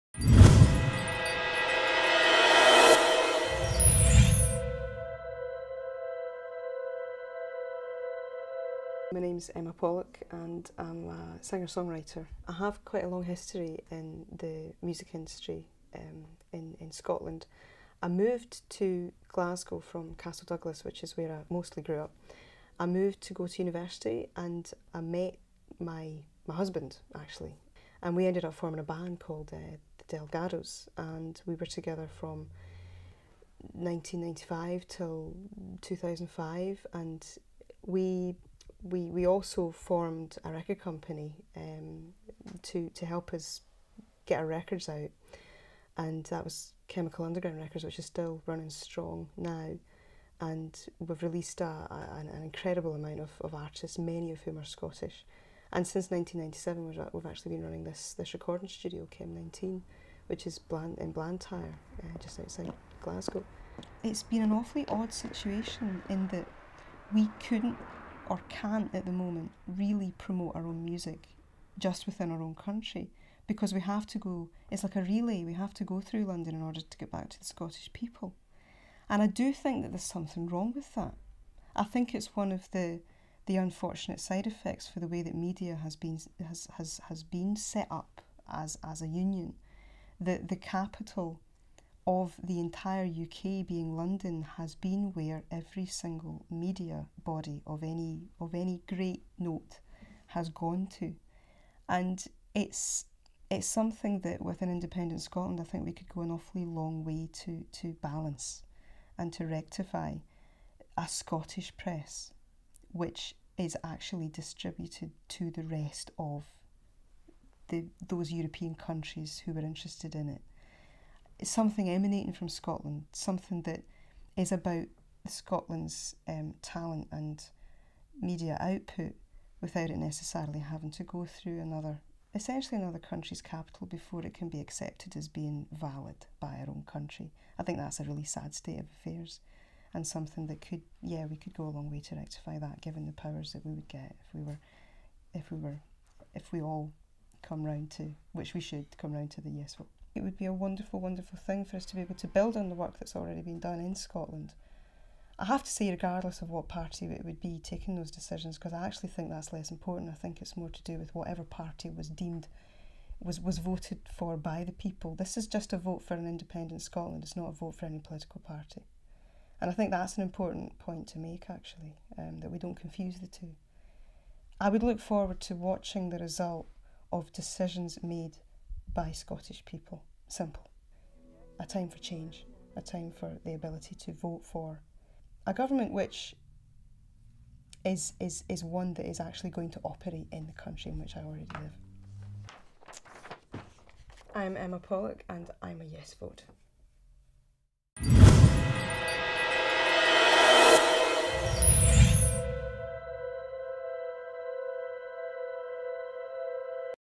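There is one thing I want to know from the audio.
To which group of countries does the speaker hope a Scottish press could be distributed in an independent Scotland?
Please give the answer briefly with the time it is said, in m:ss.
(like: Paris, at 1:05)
European countries, at 1:58.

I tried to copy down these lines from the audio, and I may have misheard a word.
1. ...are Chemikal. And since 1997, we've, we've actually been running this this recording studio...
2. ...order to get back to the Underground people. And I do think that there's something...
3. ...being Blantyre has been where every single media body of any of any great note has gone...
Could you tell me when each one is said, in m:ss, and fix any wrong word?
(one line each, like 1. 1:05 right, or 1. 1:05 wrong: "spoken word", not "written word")
1. 0:54 wrong: "Scottish", not "Chemikal"
2. 1:16 wrong: "Scottish", not "Underground"
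3. 1:33 wrong: "London", not "Blantyre".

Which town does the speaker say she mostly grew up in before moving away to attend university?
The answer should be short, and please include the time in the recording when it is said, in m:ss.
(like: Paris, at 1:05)
Castle Douglas, at 0:20.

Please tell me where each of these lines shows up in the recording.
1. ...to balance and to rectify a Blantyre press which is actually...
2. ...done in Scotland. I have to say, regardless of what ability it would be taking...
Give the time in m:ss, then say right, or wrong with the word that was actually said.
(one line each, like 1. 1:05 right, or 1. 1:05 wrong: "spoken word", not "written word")
1. 1:47 wrong: "Scottish", not "Blantyre"
2. 2:33 wrong: "party", not "ability".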